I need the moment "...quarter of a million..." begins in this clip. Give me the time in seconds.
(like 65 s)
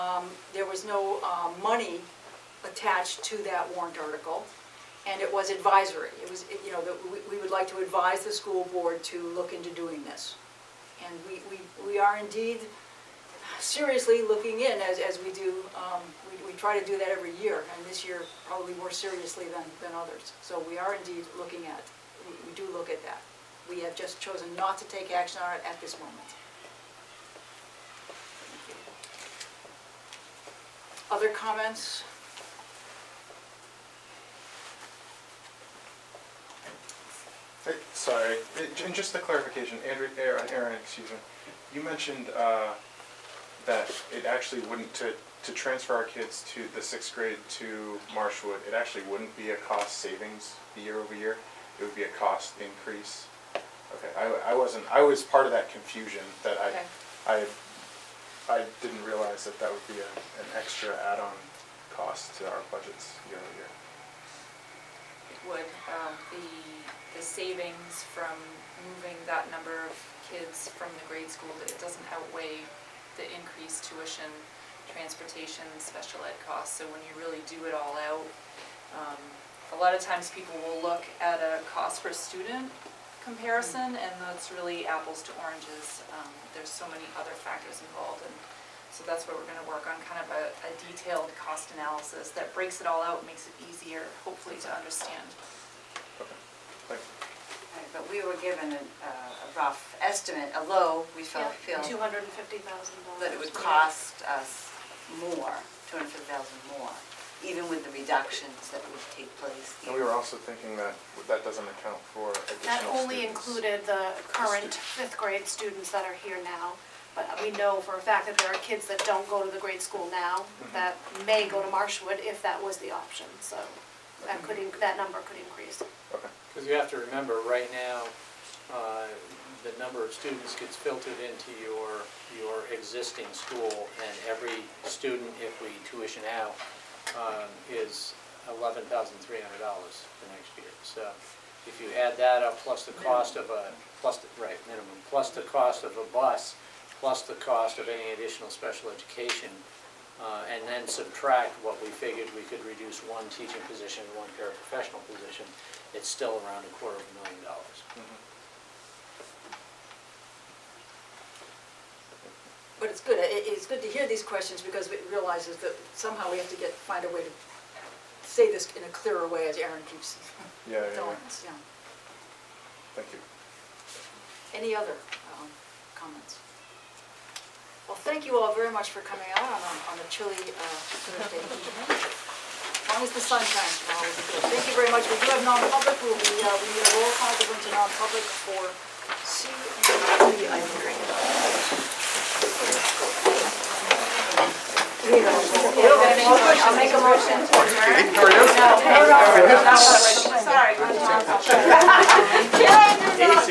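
156 s.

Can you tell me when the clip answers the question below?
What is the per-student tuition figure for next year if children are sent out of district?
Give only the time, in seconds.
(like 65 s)
138 s.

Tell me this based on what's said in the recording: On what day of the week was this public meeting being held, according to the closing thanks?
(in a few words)
Thursday.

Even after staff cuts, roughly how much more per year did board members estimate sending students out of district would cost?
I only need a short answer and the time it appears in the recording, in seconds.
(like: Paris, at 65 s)
250000, at 105 s.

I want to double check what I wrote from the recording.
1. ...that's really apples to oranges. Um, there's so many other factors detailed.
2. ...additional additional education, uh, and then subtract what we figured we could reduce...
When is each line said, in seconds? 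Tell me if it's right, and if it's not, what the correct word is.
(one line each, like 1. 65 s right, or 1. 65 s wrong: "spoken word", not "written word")
1. 84 s wrong: "involved", not "detailed"
2. 148 s wrong: "special", not "additional".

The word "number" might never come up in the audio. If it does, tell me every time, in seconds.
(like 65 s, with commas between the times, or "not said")
69 s, 124 s, 129 s.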